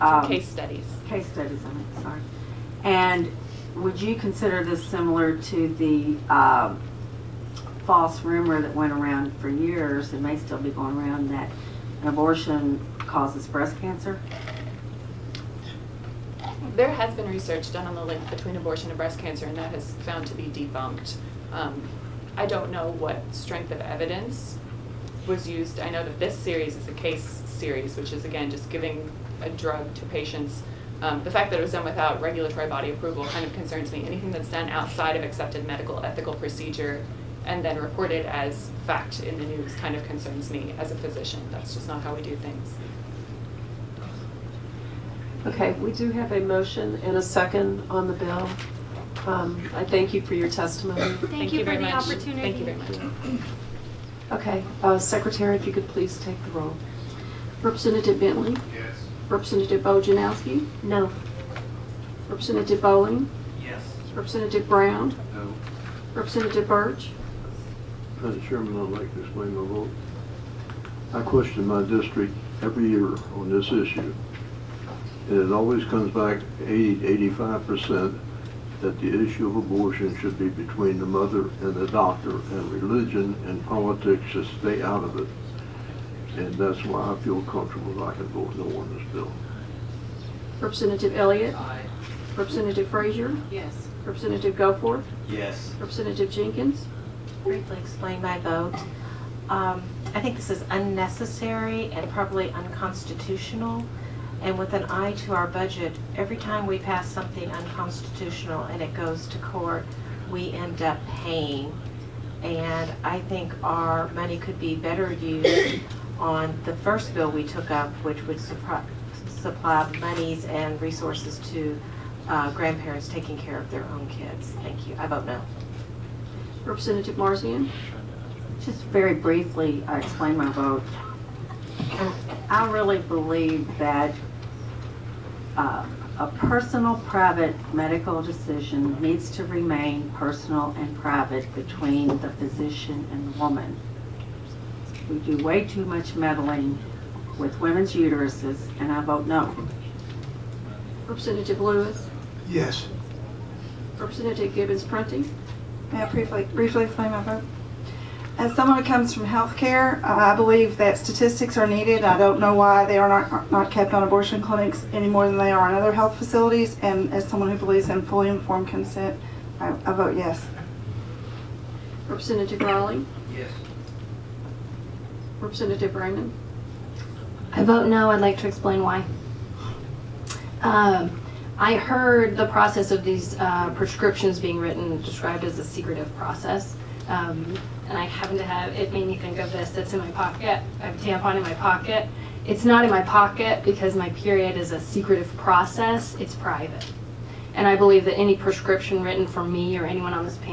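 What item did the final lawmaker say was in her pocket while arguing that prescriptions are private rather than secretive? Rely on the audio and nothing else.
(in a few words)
a tampon.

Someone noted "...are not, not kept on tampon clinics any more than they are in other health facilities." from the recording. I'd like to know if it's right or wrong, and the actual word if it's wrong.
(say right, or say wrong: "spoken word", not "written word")
wrong: "abortion", not "tampon".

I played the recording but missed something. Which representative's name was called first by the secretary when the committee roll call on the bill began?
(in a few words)
Bentley.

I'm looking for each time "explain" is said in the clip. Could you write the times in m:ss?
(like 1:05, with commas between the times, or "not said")
1:09, 1:37, 2:10, 2:36, 2:58.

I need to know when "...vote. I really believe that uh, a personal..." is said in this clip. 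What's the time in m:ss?
2:10.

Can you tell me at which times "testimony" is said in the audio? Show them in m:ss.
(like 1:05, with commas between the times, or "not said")
0:50.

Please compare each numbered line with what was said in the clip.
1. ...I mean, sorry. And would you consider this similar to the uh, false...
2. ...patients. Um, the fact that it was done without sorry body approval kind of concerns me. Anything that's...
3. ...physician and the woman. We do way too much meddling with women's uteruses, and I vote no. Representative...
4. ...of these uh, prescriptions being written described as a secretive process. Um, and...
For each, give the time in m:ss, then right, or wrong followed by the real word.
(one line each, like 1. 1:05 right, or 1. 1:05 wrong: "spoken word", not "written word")
1. 0:01 right
2. 0:30 wrong: "regulatory", not "sorry"
3. 2:22 right
4. 3:02 right.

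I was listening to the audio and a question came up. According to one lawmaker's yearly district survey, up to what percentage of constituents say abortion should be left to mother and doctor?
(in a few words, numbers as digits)
85%.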